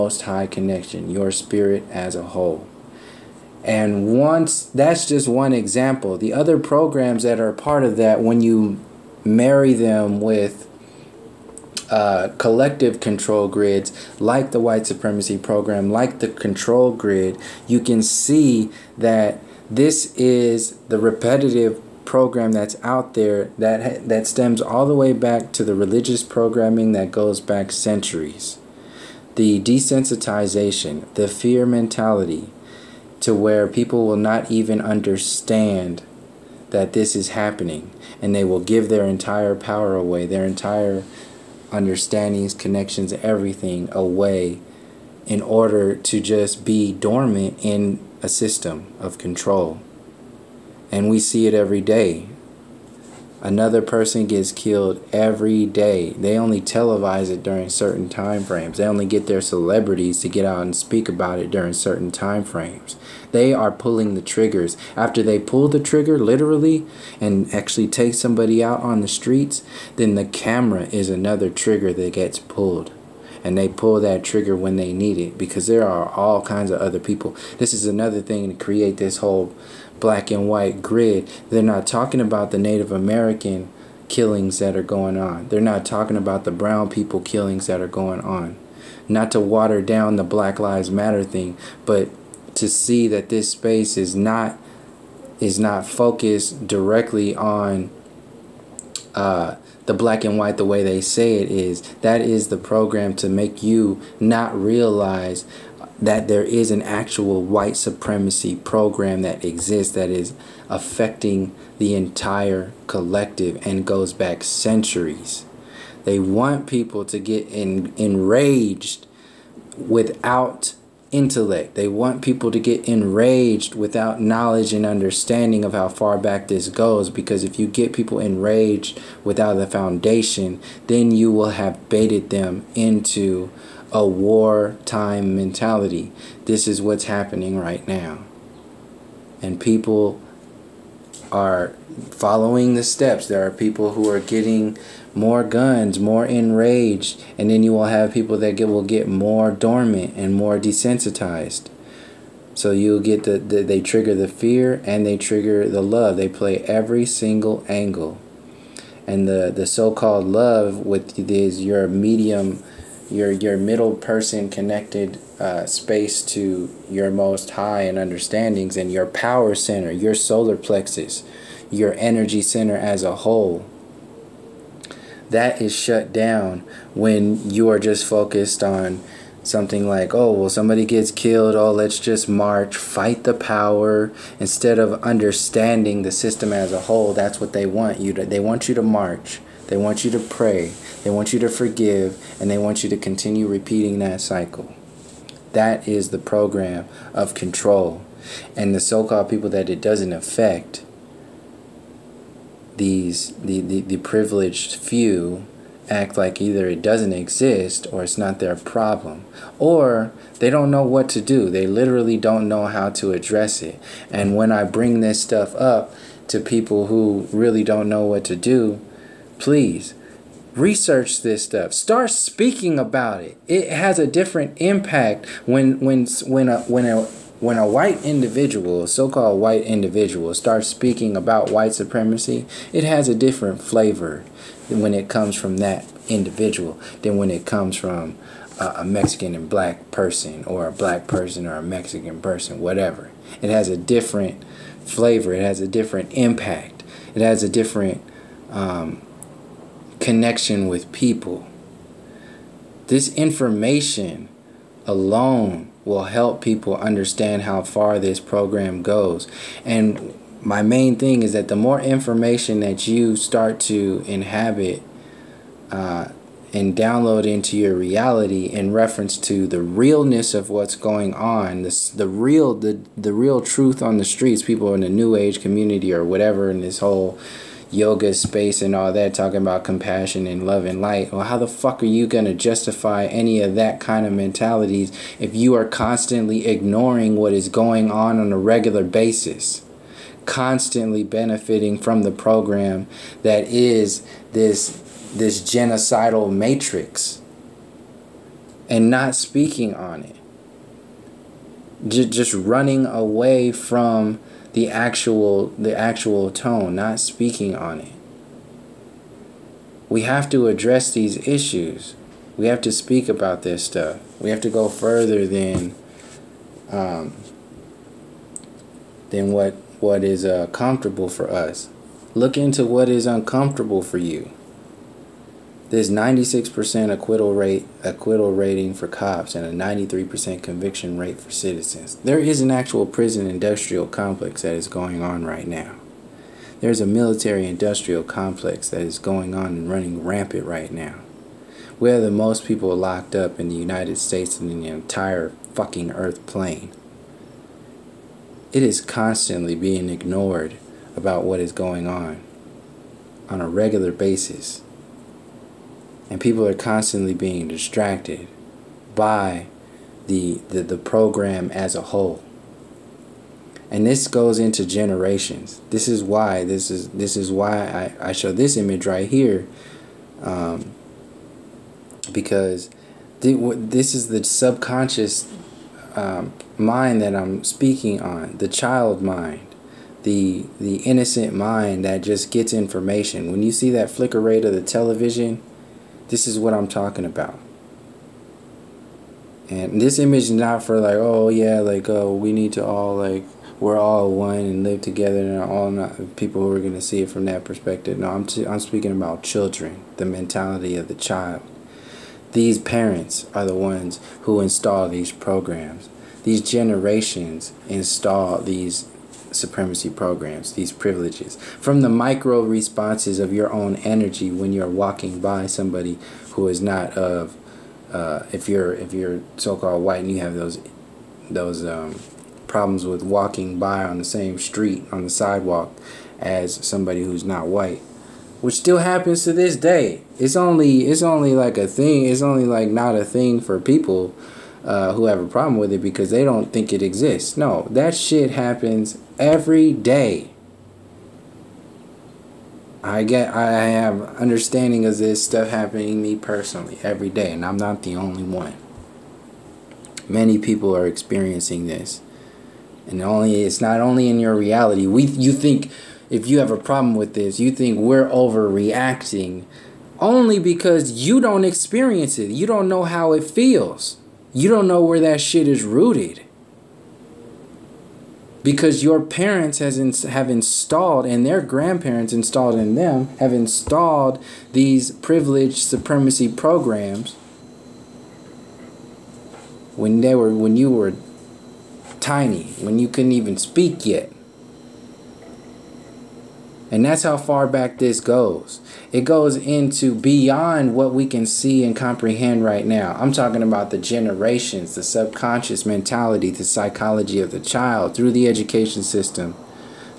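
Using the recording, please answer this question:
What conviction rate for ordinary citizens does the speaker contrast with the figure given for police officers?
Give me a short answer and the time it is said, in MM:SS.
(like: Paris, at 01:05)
93%, at 05:29.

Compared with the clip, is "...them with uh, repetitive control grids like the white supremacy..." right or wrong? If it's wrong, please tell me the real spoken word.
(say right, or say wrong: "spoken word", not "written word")
wrong: "collective", not "repetitive".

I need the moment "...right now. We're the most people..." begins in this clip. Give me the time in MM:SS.
05:40.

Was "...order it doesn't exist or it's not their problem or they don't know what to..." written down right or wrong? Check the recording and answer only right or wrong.
wrong.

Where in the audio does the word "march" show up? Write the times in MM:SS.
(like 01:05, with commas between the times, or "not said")
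03:02, 03:08.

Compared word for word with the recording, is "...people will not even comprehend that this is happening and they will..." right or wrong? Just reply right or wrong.
wrong.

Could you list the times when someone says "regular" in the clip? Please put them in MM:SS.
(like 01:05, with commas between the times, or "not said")
04:48, 05:53.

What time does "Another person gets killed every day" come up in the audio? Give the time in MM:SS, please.
00:53.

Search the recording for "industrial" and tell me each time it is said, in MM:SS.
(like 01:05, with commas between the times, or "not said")
05:33, 05:37.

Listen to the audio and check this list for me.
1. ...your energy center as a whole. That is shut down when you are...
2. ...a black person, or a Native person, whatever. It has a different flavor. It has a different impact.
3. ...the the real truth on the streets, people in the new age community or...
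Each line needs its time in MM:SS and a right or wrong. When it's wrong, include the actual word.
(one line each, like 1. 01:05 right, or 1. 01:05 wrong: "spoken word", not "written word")
1. 02:51 right
2. 04:00 wrong: "Mexican", not "Native"
3. 04:32 right.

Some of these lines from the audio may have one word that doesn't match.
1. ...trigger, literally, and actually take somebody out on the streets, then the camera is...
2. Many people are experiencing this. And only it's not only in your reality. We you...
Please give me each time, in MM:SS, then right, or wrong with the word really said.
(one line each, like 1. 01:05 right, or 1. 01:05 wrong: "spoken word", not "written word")
1. 01:05 right
2. 07:30 right.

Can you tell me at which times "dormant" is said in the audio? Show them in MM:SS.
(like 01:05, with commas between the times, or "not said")
00:46, 02:29.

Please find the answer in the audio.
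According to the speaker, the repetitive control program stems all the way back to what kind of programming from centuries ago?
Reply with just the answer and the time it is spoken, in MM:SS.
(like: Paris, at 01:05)
religious programming, at 00:25.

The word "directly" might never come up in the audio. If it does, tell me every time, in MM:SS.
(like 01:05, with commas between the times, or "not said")
01:36.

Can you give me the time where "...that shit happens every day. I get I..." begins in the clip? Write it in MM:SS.
07:17.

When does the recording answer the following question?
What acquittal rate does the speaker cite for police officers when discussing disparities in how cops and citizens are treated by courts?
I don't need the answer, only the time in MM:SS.
05:25.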